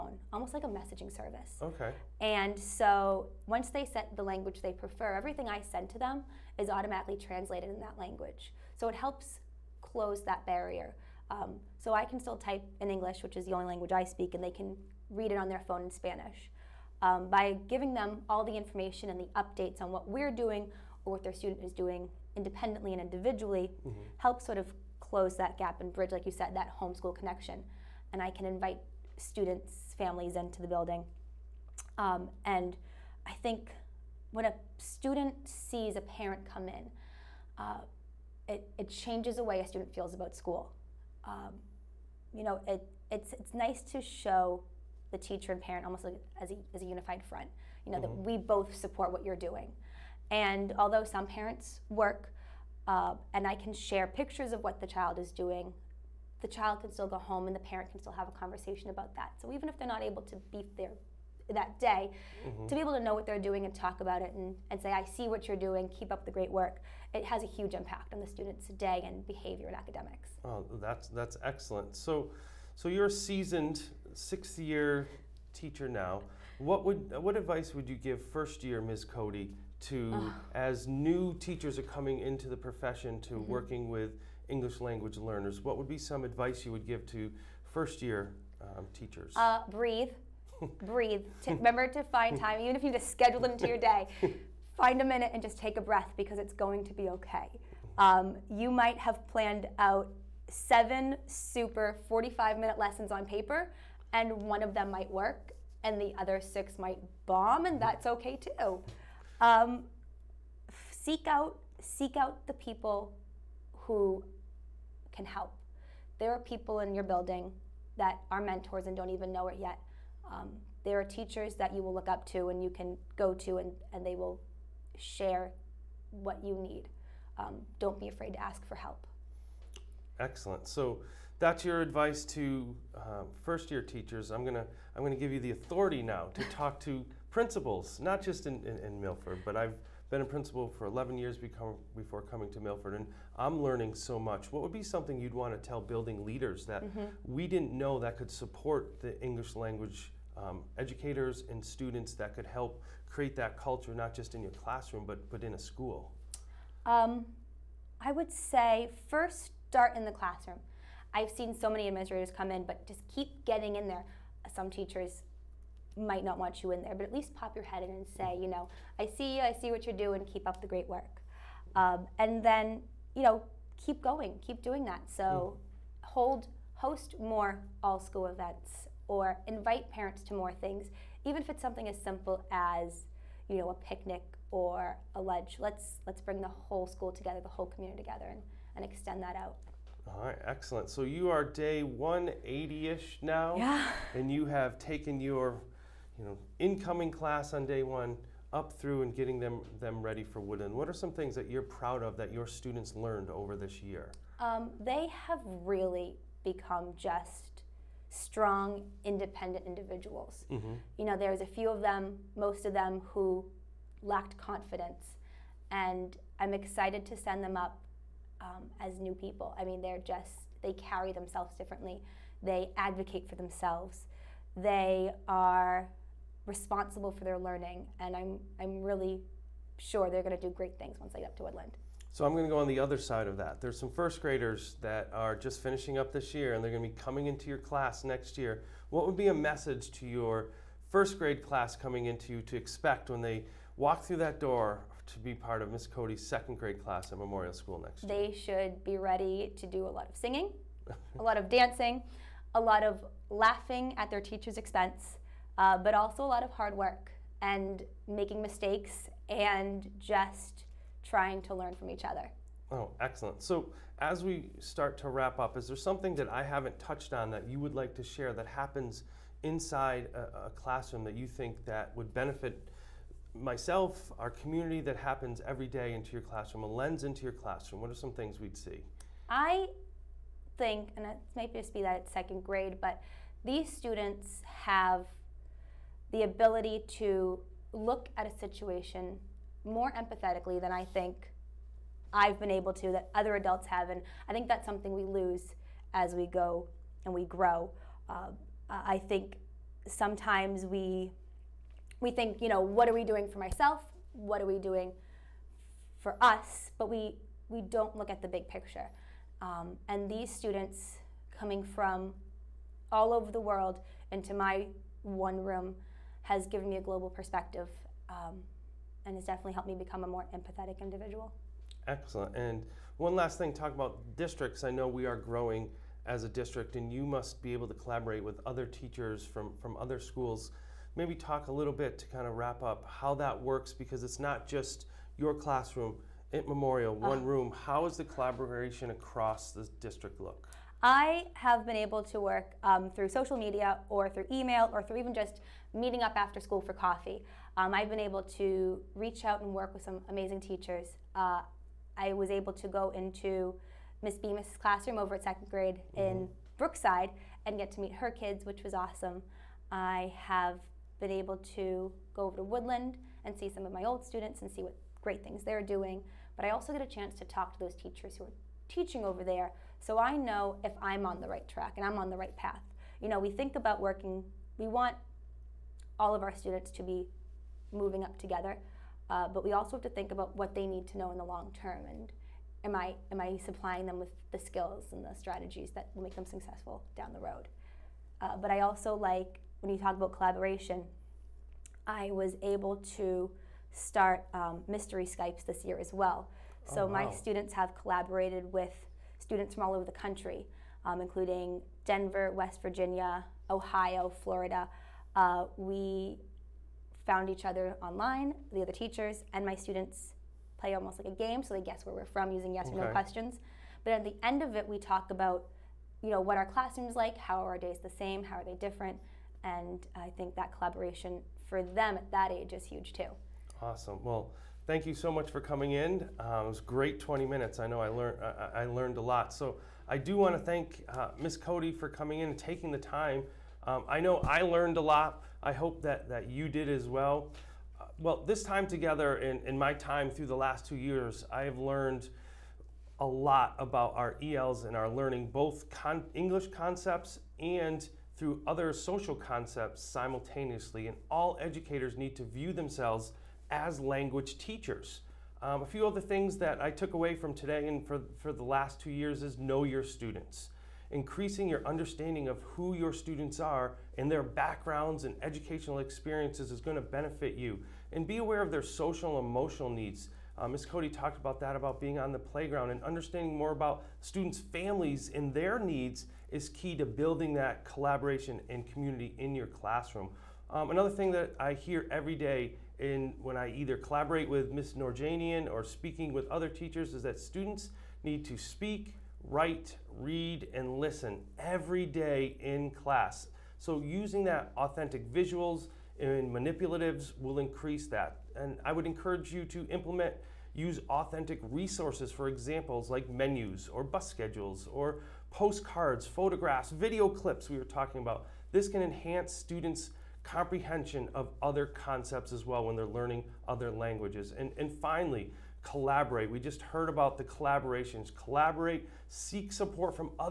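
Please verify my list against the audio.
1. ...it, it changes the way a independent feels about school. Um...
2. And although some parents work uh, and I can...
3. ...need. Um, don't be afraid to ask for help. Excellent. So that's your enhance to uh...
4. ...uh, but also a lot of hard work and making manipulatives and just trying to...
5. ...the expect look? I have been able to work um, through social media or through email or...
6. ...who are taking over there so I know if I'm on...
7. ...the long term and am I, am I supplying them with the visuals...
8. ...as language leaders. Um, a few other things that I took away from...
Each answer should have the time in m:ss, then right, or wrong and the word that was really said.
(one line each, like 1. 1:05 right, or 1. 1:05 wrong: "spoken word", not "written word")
1. 0:38 wrong: "student", not "independent"
2. 0:50 right
3. 2:06 wrong: "advice", not "enhance"
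4. 4:15 wrong: "mistakes", not "manipulatives"
5. 5:39 wrong: "district", not "expect"
6. 6:08 wrong: "teaching", not "taking"
7. 6:21 wrong: "skills", not "visuals"
8. 7:33 wrong: "teachers", not "leaders".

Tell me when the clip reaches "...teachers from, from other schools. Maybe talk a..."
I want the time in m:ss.
5:28.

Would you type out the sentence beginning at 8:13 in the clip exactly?
So using that authentic visuals and manipulatives will increase that.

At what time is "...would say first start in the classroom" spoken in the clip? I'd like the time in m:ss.
2:38.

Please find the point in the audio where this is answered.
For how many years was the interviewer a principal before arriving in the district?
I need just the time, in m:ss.
2:20.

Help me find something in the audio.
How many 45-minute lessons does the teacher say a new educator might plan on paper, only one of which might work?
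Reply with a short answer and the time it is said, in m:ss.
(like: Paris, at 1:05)
7, at 1:40.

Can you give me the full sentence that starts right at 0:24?
helps sort of close that gap and bridge, like you said, that homeschool connection.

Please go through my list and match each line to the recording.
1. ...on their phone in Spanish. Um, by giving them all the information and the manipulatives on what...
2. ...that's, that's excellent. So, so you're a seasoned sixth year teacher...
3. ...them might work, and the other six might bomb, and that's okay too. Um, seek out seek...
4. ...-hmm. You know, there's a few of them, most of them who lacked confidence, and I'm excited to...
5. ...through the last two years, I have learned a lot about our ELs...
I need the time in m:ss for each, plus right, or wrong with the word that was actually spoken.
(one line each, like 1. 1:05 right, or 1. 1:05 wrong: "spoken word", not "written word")
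1. 0:15 wrong: "updates", not "manipulatives"
2. 1:10 right
3. 1:44 right
4. 3:30 right
5. 7:20 right.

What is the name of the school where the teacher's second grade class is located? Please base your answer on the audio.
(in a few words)
Memorial School.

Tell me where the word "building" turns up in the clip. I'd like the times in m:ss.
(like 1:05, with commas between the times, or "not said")
0:30, 1:57, 2:25, 7:56.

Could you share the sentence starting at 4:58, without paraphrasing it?
Uh, I think sometimes we we think, you know, what are we doing for myself?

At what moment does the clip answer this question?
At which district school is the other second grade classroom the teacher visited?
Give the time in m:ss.
5:56.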